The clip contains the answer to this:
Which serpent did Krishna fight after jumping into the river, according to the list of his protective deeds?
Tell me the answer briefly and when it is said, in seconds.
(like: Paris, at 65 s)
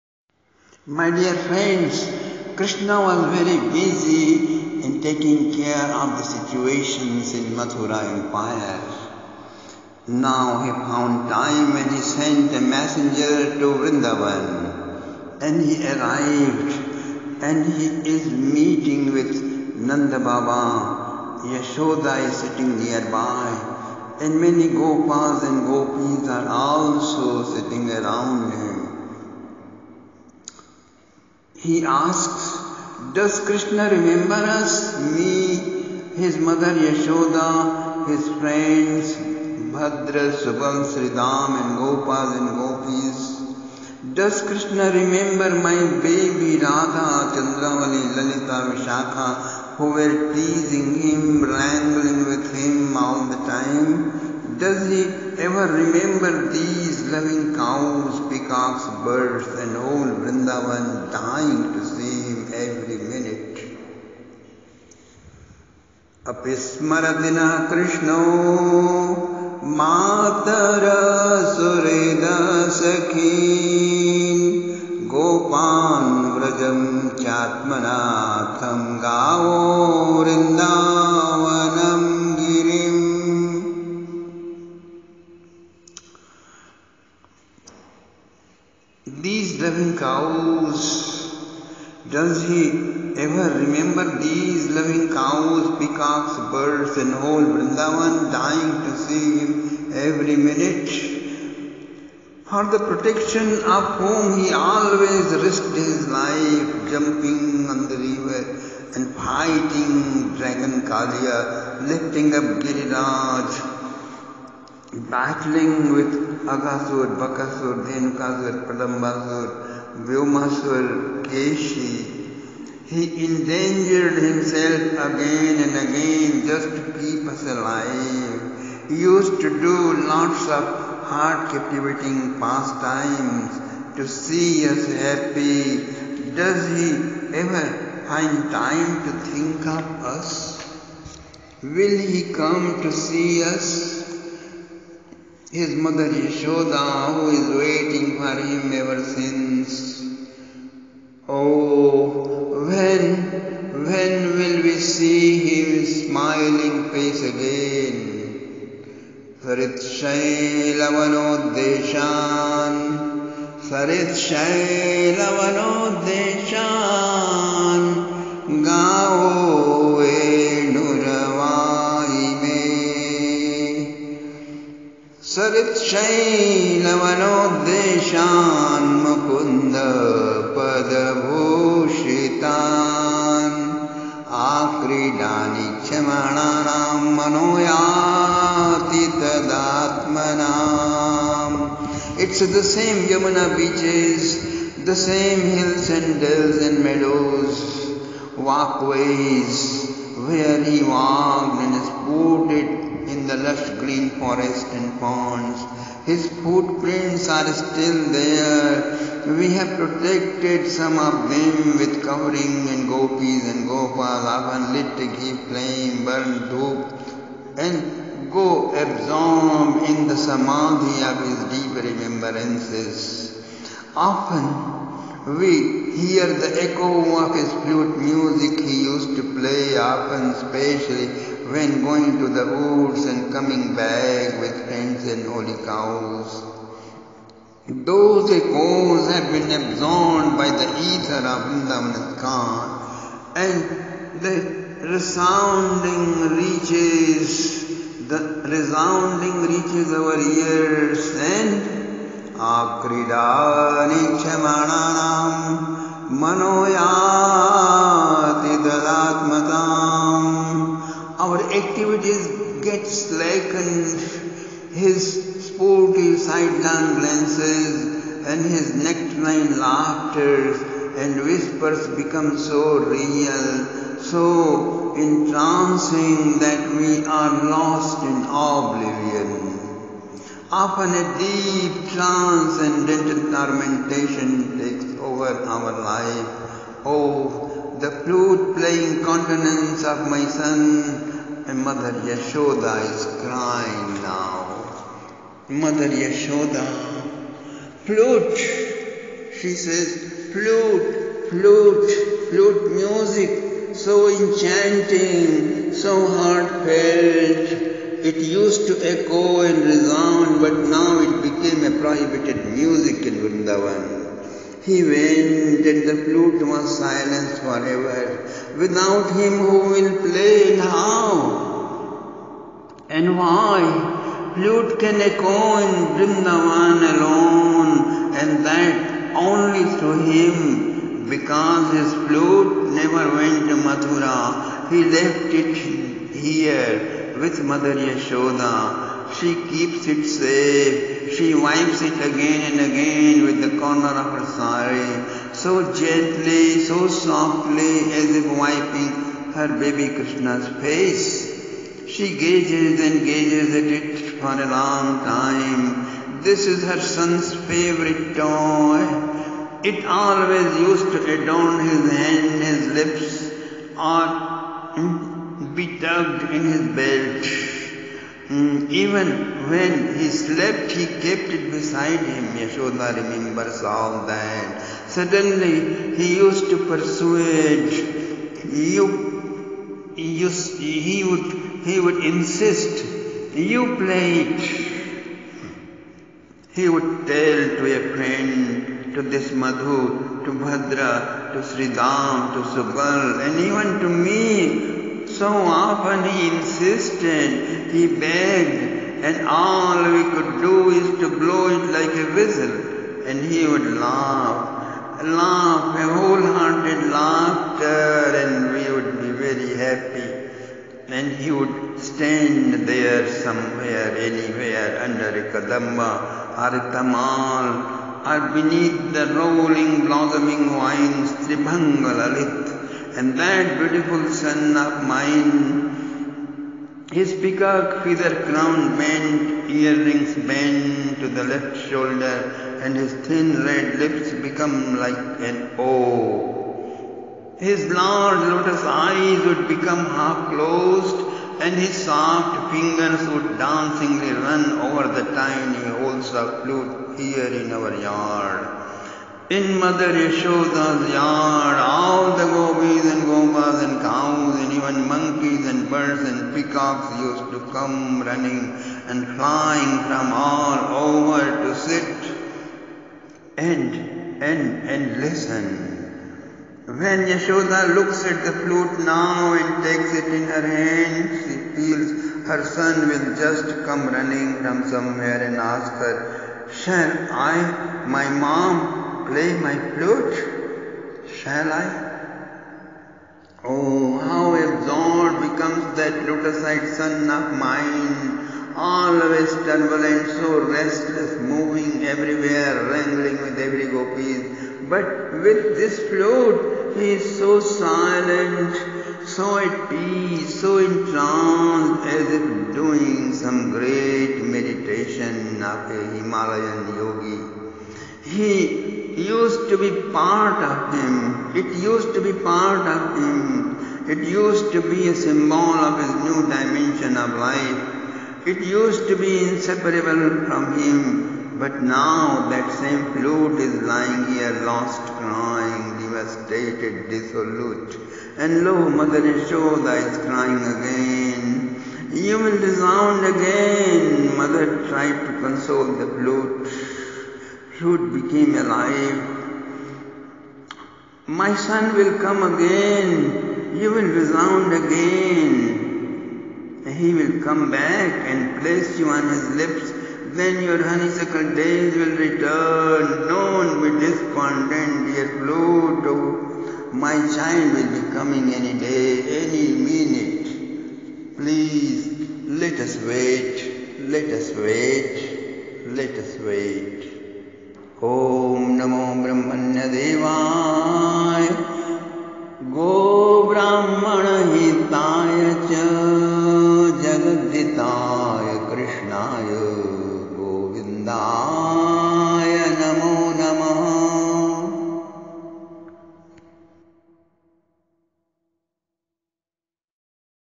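Kalia, at 110 s.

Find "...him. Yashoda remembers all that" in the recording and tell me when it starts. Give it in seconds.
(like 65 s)
371 s.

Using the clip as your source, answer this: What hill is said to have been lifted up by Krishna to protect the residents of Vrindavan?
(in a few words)
Giriraj.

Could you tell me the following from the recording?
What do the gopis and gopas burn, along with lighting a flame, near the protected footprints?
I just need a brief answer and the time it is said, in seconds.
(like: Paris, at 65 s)
dhoop, at 216 s.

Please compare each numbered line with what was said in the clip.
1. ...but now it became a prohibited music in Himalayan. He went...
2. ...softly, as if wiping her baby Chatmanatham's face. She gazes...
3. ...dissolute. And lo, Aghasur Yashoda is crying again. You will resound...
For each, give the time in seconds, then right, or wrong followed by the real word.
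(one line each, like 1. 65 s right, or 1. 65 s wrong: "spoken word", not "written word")
1. 310 s wrong: "Vrindavan", not "Himalayan"
2. 346 s wrong: "Krishna", not "Chatmanatham"
3. 526 s wrong: "Mother", not "Aghasur".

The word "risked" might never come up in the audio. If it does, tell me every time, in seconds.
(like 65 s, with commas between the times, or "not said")
105 s.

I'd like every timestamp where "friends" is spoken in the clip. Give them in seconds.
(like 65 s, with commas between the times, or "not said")
1 s, 38 s, 234 s, 387 s.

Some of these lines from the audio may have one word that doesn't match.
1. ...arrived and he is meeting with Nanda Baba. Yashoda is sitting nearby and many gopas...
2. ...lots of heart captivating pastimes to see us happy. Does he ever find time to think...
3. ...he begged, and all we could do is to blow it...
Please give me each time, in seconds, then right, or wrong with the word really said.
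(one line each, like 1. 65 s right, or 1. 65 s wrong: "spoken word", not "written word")
1. 15 s right
2. 130 s right
3. 397 s right.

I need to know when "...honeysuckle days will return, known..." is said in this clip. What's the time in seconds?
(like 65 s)
550 s.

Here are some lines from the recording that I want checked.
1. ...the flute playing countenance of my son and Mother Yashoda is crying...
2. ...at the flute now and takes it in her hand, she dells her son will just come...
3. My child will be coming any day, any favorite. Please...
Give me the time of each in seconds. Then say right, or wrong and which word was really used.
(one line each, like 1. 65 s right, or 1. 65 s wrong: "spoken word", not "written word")
1. 287 s right
2. 468 s wrong: "feels", not "dells"
3. 556 s wrong: "minute", not "favorite".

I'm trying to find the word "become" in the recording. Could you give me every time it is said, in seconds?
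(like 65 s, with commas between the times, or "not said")
272 s, 434 s, 439 s, 485 s.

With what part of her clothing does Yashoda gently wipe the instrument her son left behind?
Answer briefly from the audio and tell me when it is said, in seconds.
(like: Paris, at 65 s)
corner of her sari, at 343 s.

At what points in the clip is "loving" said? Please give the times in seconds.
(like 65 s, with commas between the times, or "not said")
57 s, 94 s.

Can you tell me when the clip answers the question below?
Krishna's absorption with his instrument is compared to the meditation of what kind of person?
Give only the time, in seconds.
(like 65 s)
505 s.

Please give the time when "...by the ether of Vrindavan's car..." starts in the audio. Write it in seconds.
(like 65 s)
240 s.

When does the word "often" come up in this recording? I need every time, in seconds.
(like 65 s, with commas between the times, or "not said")
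214 s, 223 s, 229 s, 280 s, 395 s.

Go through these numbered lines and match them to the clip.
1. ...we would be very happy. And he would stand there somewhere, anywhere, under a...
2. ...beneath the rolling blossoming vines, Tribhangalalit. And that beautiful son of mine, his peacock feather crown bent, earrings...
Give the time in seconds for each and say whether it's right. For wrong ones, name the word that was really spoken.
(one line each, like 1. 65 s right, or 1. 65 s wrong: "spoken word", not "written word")
1. 408 s right
2. 418 s right.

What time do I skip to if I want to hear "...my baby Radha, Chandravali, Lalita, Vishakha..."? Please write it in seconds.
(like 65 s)
45 s.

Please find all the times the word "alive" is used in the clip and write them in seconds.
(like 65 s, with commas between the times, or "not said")
127 s, 538 s.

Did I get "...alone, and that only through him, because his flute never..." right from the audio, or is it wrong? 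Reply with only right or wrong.
right.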